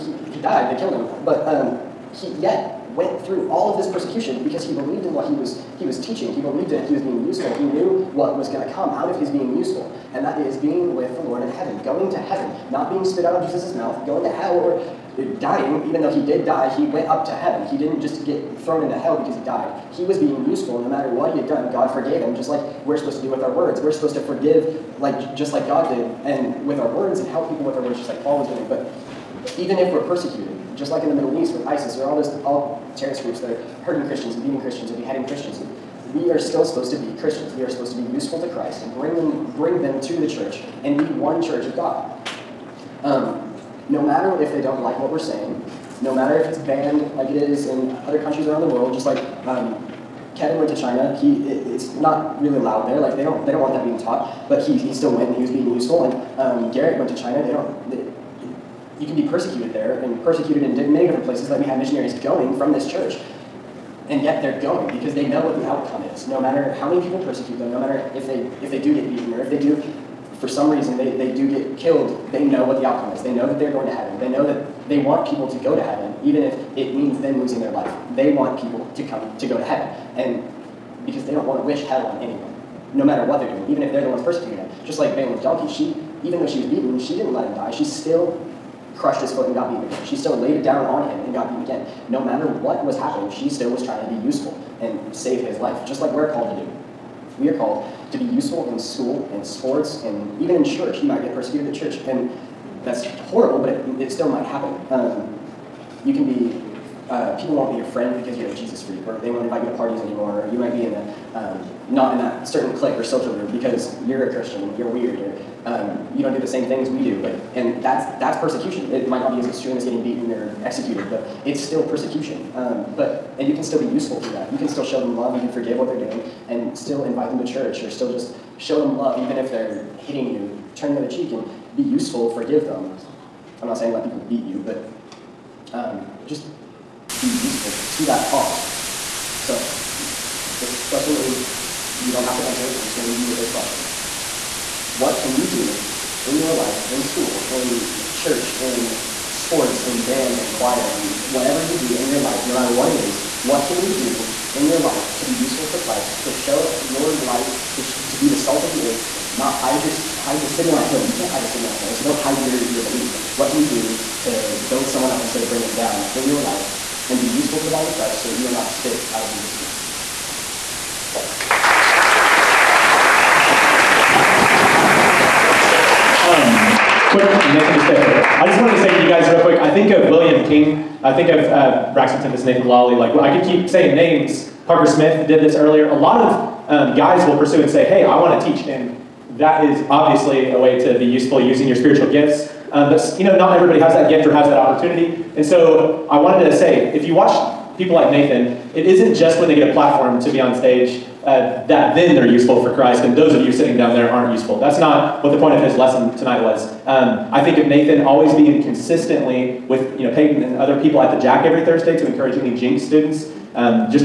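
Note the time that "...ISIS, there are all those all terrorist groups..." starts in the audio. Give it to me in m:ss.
0:31.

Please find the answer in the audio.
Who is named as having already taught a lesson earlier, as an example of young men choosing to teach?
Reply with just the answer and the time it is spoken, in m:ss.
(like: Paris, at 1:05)
Parker Smith, at 3:04.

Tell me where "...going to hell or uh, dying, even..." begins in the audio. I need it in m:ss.
0:14.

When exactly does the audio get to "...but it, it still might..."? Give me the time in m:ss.
1:43.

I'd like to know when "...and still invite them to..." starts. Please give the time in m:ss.
2:06.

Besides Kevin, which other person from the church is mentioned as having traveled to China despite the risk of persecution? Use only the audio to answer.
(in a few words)
Garrett.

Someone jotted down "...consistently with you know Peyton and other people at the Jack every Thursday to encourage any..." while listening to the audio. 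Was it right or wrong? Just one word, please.
right.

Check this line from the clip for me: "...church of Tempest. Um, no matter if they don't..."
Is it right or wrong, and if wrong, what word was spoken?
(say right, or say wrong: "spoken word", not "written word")
wrong: "God", not "Tempest".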